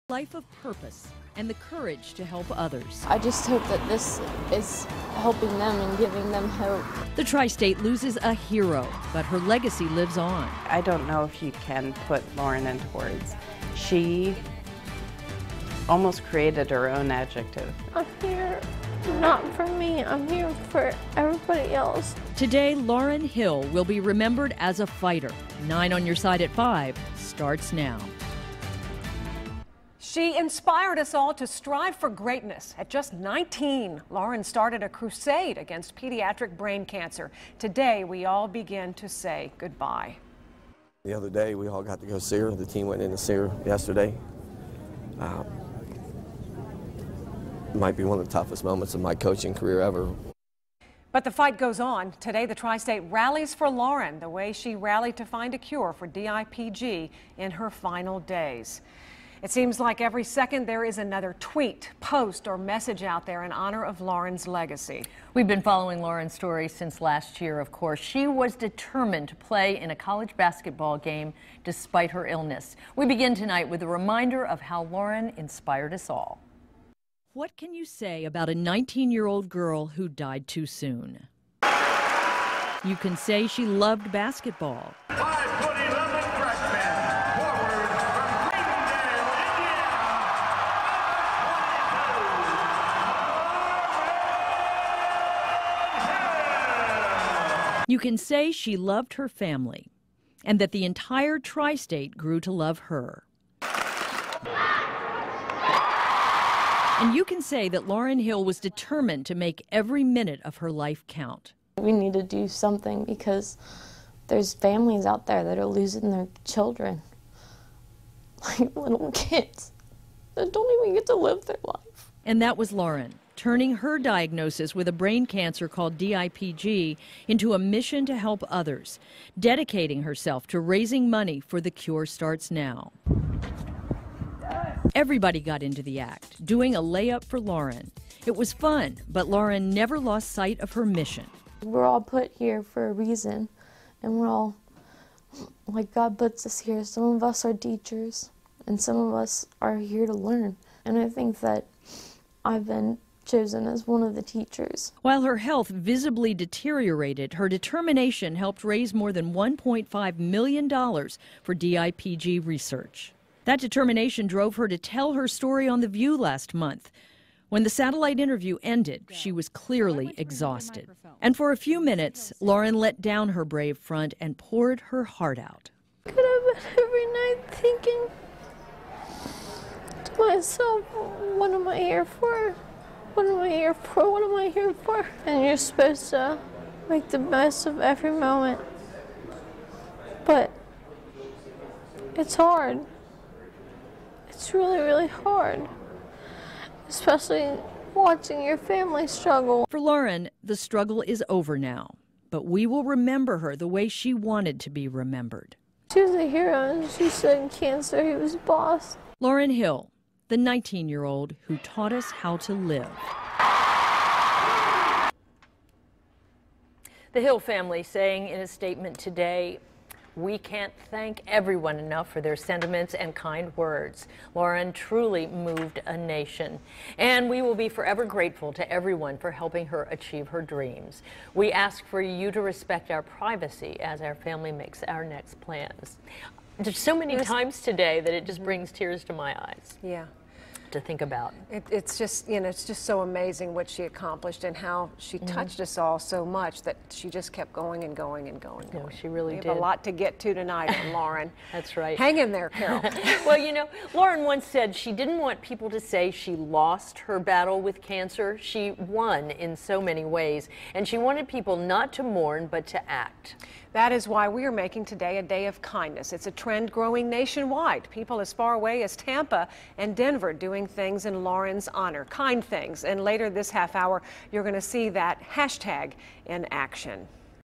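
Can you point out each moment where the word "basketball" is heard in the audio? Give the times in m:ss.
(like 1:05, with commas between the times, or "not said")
1:10, 1:24.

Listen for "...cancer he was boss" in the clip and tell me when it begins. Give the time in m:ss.
3:27.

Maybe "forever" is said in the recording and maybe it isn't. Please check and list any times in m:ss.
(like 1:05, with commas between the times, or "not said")
3:47.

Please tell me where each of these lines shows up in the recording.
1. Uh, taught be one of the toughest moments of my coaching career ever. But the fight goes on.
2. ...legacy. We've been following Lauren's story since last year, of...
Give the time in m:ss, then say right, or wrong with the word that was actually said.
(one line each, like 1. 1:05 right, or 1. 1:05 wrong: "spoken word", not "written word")
1. 0:45 wrong: "might", not "taught"
2. 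1:04 right.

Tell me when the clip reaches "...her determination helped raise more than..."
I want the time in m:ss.
2:37.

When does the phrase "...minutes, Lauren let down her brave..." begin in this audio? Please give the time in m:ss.
2:51.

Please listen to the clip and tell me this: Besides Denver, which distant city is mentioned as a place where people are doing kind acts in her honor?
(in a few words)
Tampa.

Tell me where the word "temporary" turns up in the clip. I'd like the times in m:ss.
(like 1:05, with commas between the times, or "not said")
not said.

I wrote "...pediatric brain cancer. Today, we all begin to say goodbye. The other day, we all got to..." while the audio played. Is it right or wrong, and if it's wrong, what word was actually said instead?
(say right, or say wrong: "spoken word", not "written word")
right.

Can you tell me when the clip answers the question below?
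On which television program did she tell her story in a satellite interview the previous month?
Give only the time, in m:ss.
2:45.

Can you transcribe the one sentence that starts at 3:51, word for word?
We ask for you to respect our privacy as our family makes our next plans.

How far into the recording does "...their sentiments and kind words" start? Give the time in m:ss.
3:42.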